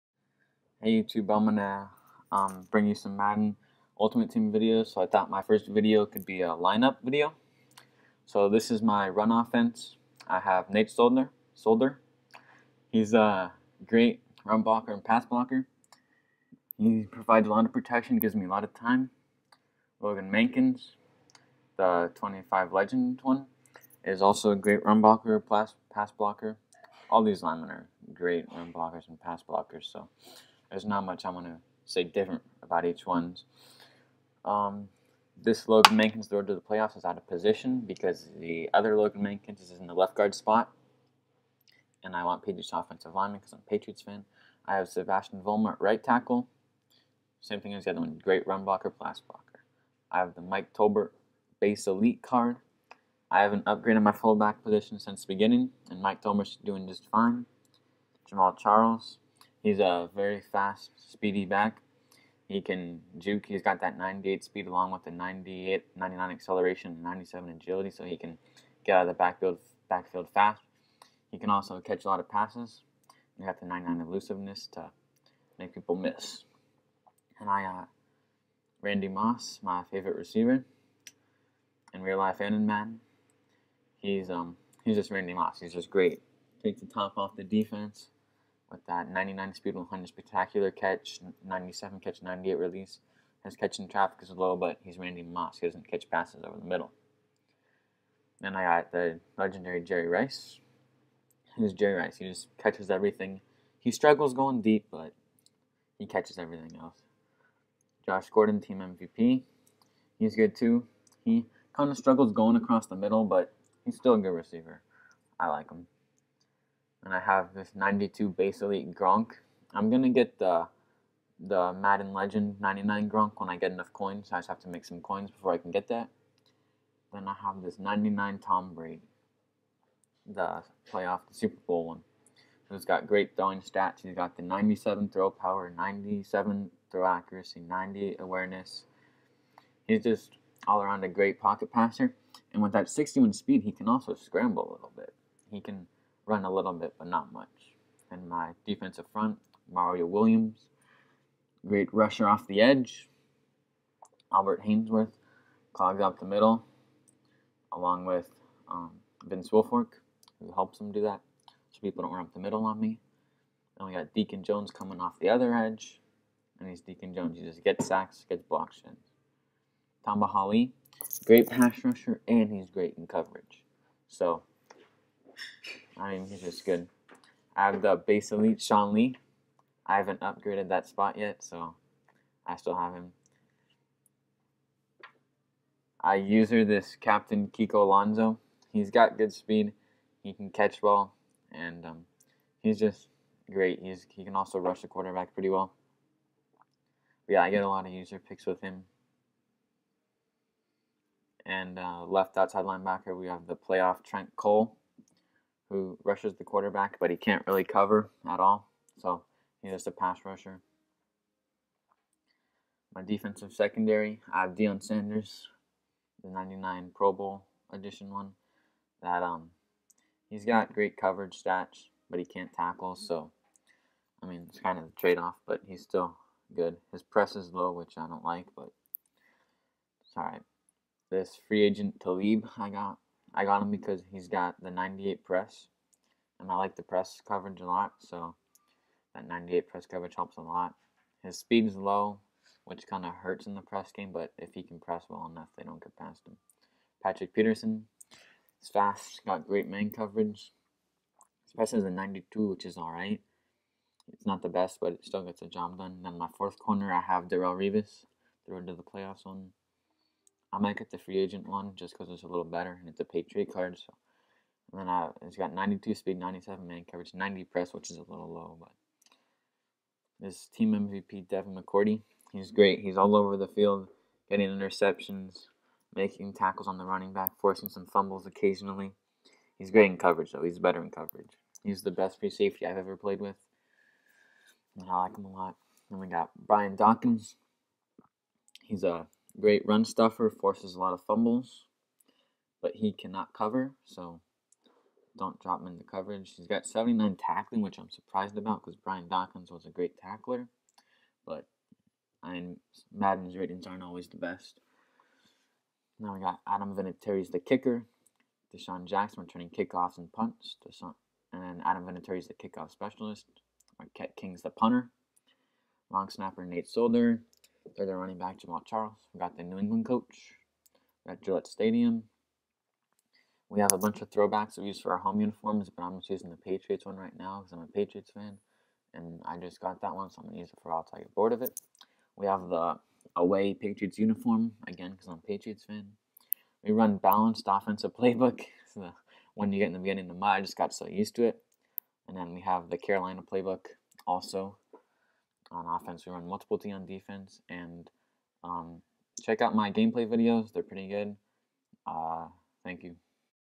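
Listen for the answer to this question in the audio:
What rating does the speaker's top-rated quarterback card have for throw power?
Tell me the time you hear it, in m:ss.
2:14.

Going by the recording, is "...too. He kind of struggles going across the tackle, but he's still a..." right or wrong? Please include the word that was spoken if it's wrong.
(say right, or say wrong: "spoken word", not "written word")
wrong: "middle", not "tackle".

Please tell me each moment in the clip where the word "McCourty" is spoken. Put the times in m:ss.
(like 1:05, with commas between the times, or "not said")
4:31.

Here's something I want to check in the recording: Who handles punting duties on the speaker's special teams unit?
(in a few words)
Marquette King.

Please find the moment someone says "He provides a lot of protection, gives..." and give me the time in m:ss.
0:16.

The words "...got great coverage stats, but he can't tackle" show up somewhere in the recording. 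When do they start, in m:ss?
3:40.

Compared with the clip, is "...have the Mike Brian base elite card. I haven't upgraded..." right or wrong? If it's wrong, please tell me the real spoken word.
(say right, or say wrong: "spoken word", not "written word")
wrong: "Tolbert", not "Brian".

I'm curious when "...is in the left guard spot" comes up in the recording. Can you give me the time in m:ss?
0:39.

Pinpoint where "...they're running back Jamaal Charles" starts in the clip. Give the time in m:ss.
5:17.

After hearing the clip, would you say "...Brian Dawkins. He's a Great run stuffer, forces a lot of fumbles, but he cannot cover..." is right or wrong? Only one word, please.
right.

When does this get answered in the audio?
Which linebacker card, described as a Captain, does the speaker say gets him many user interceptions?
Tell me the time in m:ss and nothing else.
3:07.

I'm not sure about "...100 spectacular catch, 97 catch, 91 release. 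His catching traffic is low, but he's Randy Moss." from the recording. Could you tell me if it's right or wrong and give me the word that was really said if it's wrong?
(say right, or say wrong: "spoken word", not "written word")
wrong: "98", not "91".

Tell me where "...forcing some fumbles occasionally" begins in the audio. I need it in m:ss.
4:37.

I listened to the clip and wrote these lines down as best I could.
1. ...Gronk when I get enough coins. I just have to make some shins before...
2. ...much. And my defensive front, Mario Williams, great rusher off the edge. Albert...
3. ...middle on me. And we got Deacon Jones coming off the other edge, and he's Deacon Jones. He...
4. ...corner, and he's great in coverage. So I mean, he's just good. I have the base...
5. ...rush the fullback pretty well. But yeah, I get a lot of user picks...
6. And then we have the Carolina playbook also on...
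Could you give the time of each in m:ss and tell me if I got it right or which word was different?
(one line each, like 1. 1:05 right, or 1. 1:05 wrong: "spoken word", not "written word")
1. 2:03 wrong: "coins", not "shins"
2. 2:27 right
3. 2:42 right
4. 2:51 wrong: "rusher", not "corner"
5. 3:14 wrong: "quarterback", not "fullback"
6. 5:42 right.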